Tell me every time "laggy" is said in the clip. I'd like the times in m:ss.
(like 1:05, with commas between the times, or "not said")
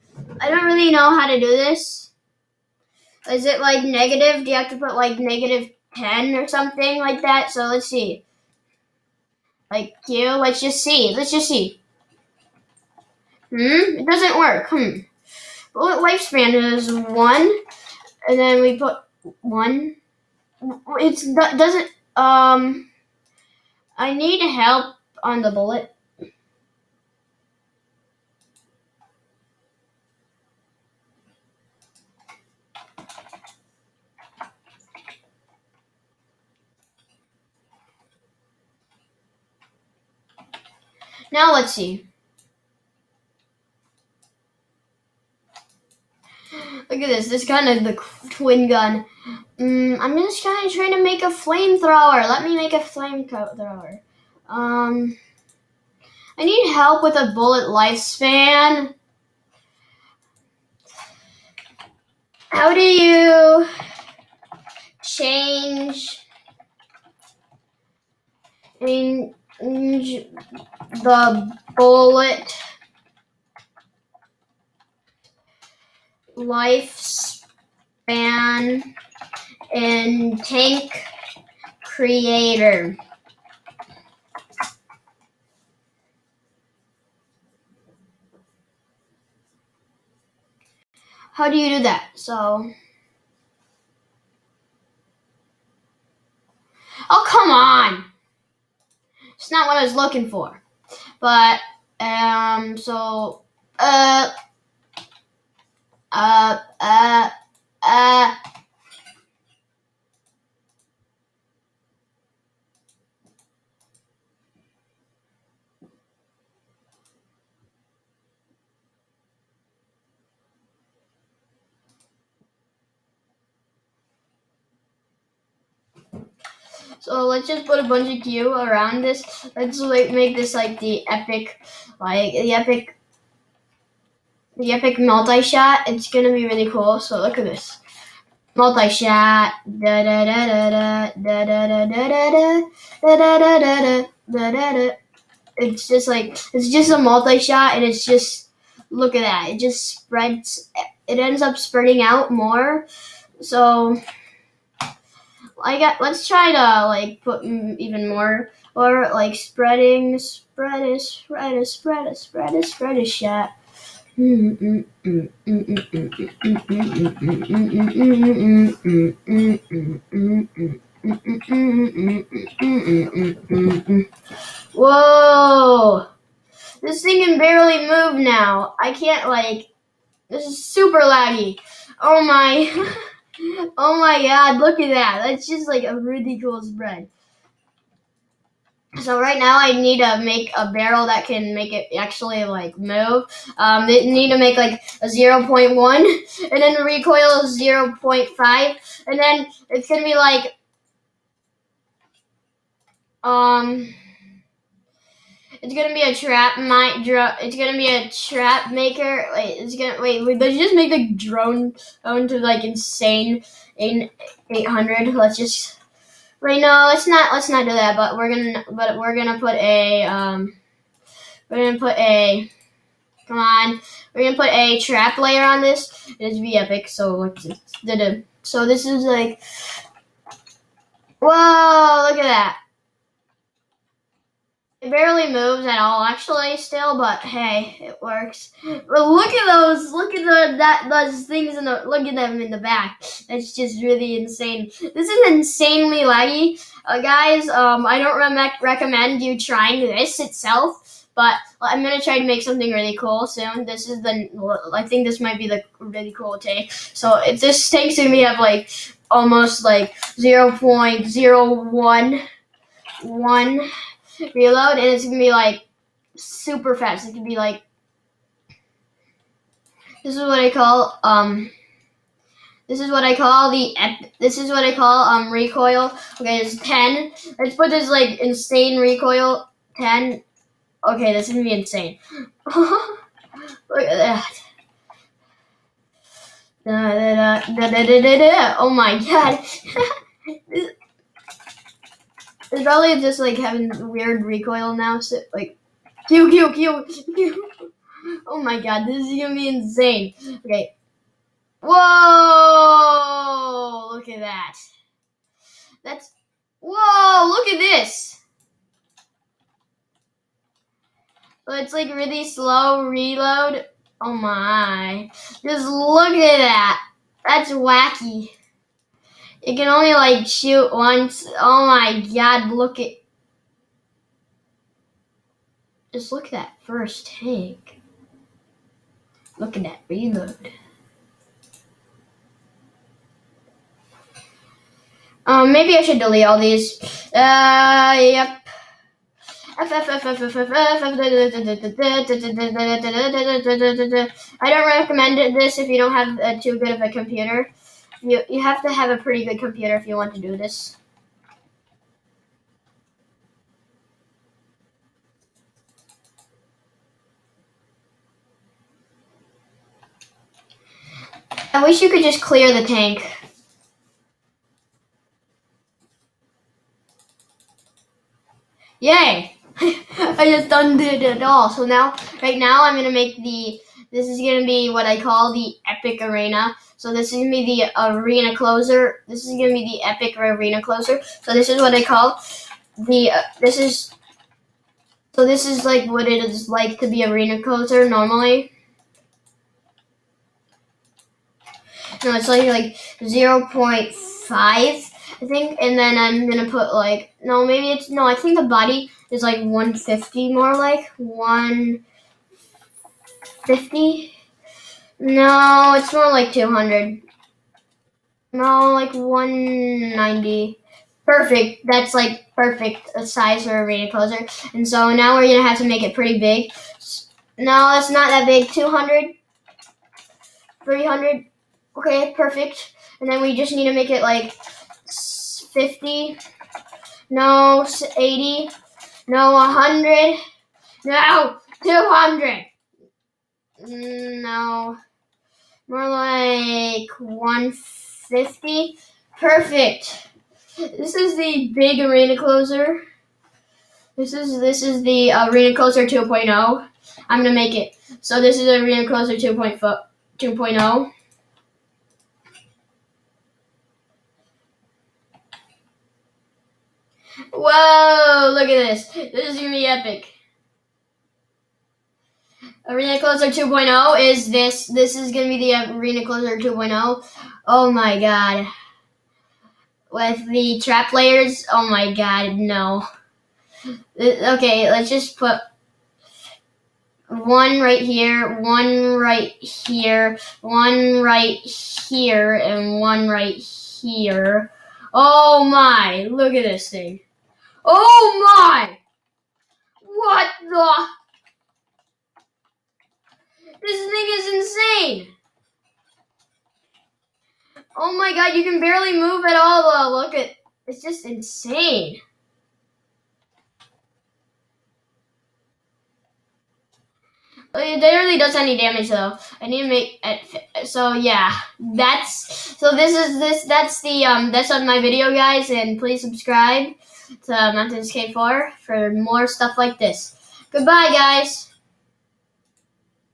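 3:00, 4:05.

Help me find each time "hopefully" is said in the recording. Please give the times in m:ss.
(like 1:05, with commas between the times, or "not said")
not said.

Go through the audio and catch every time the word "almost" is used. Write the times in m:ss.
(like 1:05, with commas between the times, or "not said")
4:19.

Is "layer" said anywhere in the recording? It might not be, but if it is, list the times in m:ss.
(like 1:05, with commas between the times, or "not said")
3:45, 7:50.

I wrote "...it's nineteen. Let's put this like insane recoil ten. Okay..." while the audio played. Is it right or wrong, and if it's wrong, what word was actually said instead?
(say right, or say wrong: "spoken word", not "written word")
wrong: "ten", not "nineteen".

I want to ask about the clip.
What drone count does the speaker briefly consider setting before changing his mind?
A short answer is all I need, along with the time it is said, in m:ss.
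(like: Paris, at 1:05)
800, at 3:34.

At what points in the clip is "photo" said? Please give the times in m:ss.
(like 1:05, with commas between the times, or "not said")
not said.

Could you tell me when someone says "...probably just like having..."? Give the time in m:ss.
4:52.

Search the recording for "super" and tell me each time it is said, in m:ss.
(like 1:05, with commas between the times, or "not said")
3:00, 4:26.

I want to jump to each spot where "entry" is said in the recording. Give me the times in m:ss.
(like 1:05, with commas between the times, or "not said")
not said.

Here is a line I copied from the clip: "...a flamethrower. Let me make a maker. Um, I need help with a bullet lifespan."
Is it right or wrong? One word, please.
wrong.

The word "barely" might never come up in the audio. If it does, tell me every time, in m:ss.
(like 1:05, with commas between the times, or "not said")
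2:57, 3:54, 8:18, 8:27.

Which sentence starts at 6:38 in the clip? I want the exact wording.
I think the body is like one fifty more like one.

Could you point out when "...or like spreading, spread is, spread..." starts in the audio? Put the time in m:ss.
2:38.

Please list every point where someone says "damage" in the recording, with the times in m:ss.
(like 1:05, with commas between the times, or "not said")
8:28.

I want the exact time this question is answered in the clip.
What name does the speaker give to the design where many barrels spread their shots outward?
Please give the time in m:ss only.
2:14.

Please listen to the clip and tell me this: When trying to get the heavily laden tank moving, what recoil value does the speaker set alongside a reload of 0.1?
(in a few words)
0.5.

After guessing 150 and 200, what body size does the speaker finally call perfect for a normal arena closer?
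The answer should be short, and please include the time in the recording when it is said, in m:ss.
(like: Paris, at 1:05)
190, at 6:48.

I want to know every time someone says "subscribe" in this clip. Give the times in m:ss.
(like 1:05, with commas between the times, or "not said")
8:36.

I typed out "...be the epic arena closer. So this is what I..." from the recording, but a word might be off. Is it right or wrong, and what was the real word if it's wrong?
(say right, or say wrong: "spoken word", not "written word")
right.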